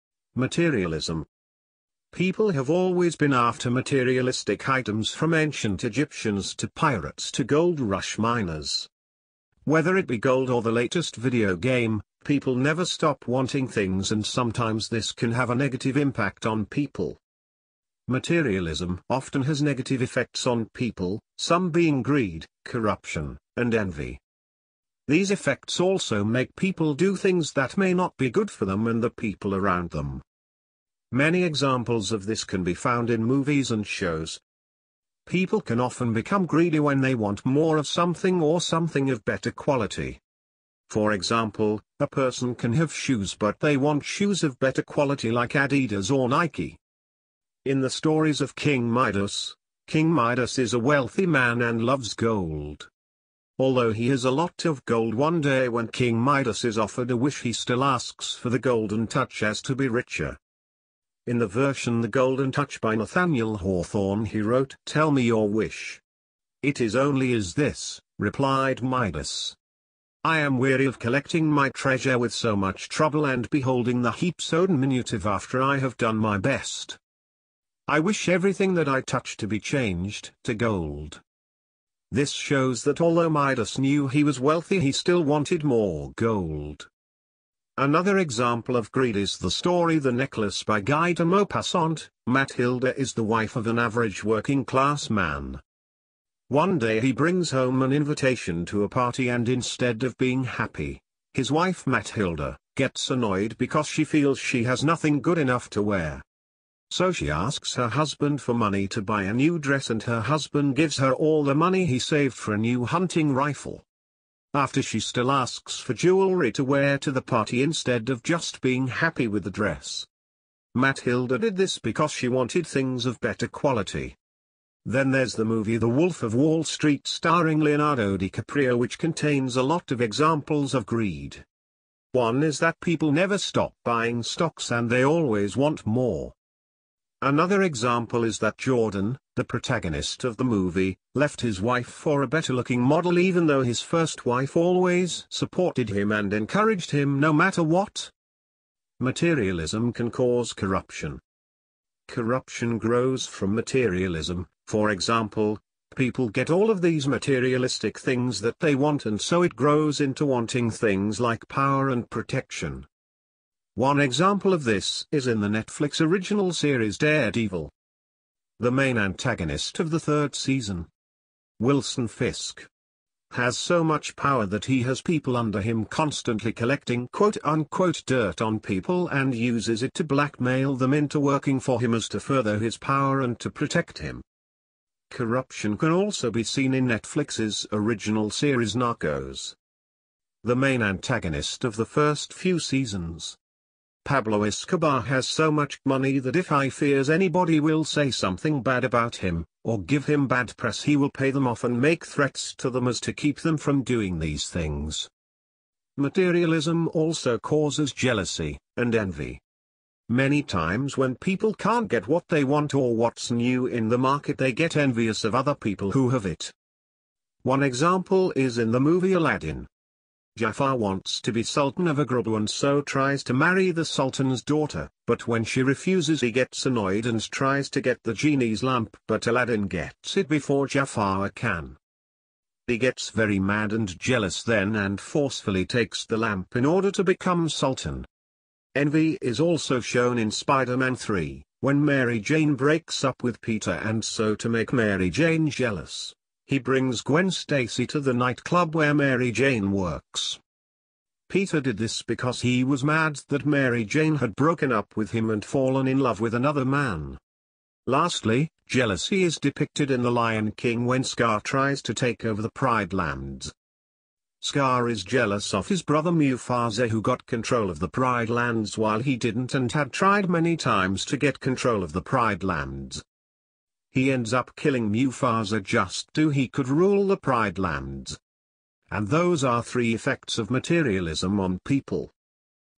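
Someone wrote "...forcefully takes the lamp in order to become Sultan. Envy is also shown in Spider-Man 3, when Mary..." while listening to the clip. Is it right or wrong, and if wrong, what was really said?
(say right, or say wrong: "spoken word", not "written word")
right.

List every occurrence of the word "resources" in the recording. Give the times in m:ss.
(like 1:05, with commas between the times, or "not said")
not said.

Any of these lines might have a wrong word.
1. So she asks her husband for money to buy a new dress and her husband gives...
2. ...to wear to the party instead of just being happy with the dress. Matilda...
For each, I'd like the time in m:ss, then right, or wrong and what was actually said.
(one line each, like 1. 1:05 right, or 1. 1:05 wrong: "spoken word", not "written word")
1. 1:46 right
2. 1:56 right.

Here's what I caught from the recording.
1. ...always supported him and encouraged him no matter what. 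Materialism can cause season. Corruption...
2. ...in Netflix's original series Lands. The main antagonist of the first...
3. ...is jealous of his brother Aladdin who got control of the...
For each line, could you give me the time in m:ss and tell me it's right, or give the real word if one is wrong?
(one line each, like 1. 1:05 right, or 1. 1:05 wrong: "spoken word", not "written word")
1. 2:24 wrong: "corruption", not "season"
2. 3:06 wrong: "Narcos", not "Lands"
3. 4:24 wrong: "Mufasa", not "Aladdin".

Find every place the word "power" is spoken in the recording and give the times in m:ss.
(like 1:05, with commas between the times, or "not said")
2:41, 2:54, 3:02.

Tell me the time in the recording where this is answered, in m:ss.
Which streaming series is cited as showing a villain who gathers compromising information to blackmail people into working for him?
2:46.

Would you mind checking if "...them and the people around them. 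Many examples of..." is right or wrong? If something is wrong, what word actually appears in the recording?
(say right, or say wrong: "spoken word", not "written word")
right.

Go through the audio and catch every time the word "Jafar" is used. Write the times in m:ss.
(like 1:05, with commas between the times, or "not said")
3:40, 3:50.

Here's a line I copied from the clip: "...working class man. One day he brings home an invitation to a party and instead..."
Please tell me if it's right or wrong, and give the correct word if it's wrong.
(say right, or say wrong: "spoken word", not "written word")
right.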